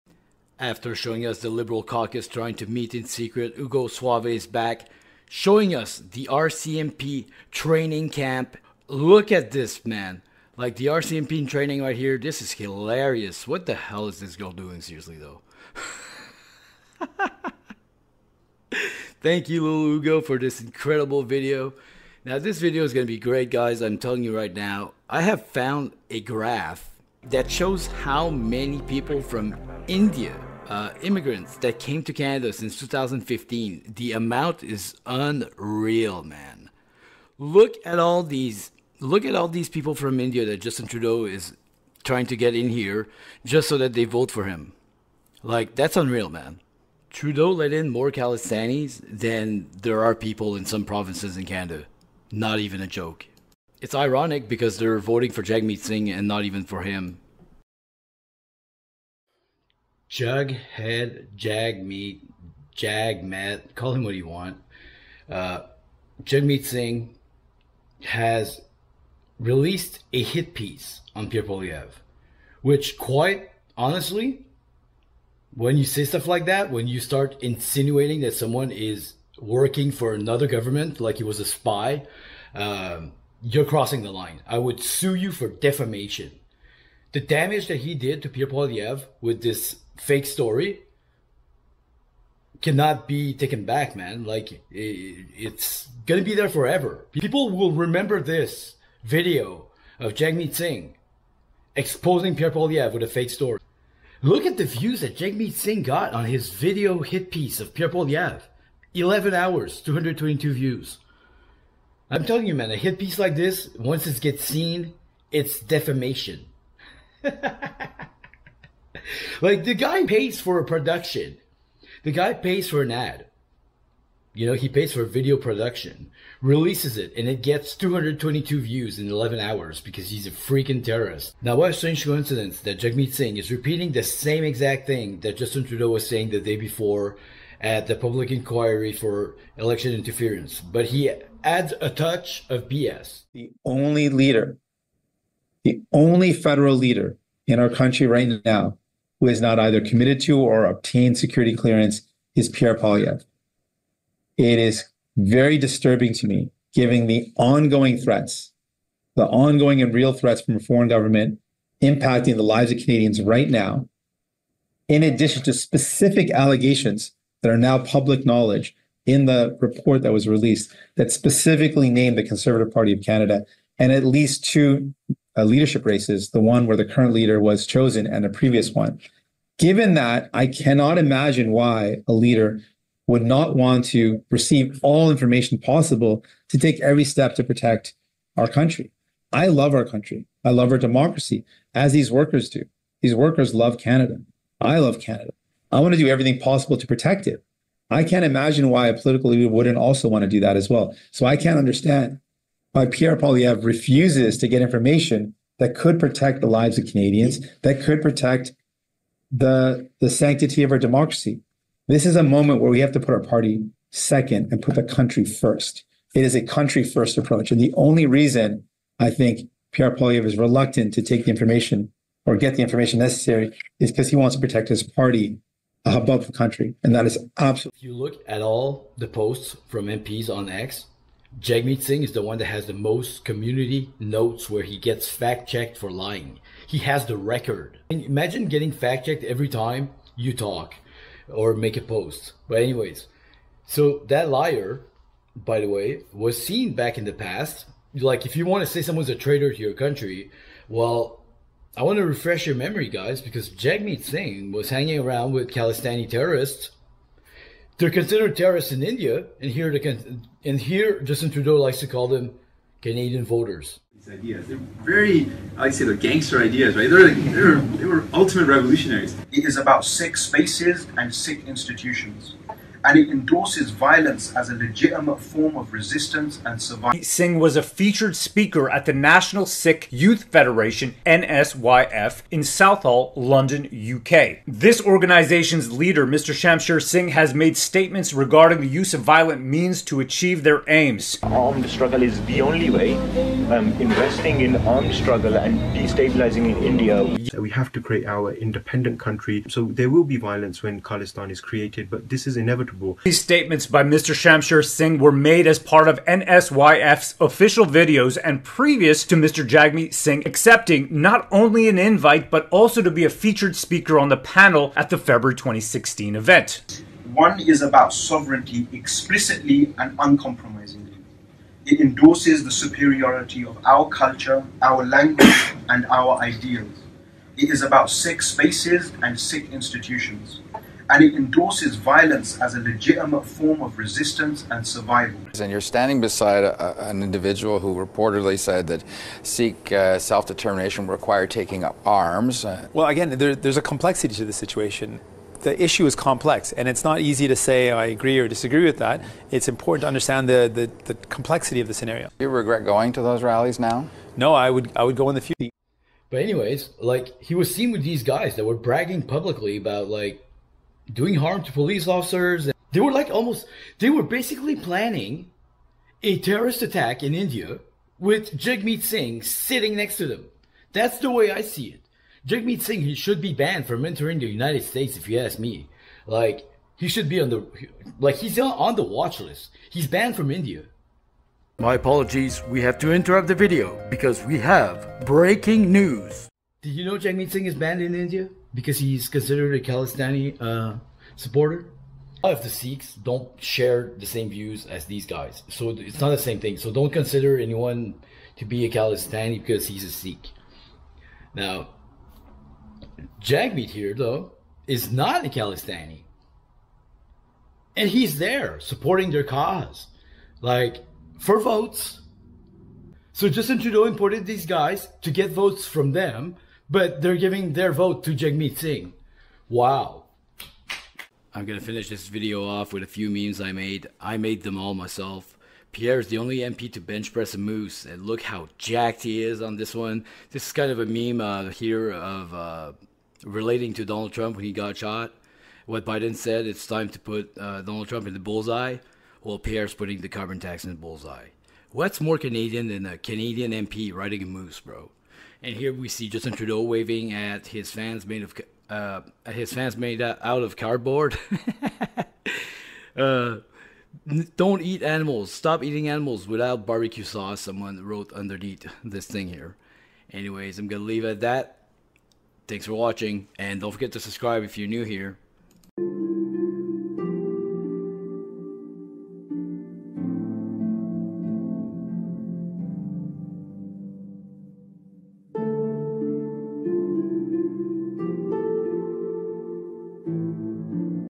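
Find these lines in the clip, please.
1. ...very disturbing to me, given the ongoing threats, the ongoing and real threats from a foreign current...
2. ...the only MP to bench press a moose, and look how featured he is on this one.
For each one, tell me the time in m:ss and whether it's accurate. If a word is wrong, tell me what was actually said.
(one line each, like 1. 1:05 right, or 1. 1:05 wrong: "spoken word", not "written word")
1. 2:35 wrong: "government", not "current"
2. 7:06 wrong: "jacked", not "featured".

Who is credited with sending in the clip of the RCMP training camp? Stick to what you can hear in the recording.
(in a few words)
Hugo Suave.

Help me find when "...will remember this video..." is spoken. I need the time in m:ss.
1:37.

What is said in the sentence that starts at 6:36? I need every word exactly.
So don't consider anyone to be a Khalistani because he's a Sikh.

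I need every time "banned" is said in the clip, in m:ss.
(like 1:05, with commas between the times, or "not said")
6:13, 6:19, 6:27.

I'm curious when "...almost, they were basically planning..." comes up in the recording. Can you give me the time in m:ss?
6:03.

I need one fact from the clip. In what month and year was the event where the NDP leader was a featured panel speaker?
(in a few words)
February 2016.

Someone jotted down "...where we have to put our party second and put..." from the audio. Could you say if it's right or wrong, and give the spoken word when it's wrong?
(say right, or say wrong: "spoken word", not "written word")
right.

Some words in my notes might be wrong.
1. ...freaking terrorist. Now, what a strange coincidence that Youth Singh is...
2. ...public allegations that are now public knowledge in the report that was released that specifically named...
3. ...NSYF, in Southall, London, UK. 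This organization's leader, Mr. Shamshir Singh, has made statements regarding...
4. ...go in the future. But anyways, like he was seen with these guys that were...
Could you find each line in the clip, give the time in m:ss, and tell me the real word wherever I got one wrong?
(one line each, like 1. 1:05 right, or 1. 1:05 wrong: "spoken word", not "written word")
1. 2:10 wrong: "Jagmeet", not "Youth"
2. 2:45 wrong: "specific", not "public"
3. 4:41 right
4. 5:54 right.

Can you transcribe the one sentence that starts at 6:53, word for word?
So Justin Trudeau imported these guys to get votes from them but they're giving their vote to Jagmeet Singh.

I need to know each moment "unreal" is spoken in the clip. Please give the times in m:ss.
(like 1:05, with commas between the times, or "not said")
0:35, 0:45.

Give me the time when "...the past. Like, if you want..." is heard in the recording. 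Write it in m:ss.
4:07.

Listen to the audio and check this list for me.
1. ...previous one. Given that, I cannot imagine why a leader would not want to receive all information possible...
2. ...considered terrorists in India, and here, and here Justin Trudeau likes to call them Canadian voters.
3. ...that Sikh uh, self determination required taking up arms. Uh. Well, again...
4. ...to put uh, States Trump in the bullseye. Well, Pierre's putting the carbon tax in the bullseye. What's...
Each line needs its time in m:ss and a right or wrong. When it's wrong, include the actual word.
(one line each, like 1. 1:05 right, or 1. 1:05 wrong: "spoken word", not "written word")
1. 2:58 right
2. 4:17 right
3. 5:38 right
4. 7:16 wrong: "Donald", not "States".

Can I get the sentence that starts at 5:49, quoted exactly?
It's important to understand the, the, the complexity of the scenario.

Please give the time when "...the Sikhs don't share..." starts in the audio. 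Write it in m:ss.
6:32.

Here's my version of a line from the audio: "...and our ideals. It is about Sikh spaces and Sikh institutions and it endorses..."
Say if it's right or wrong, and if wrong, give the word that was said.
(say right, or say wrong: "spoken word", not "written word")
right.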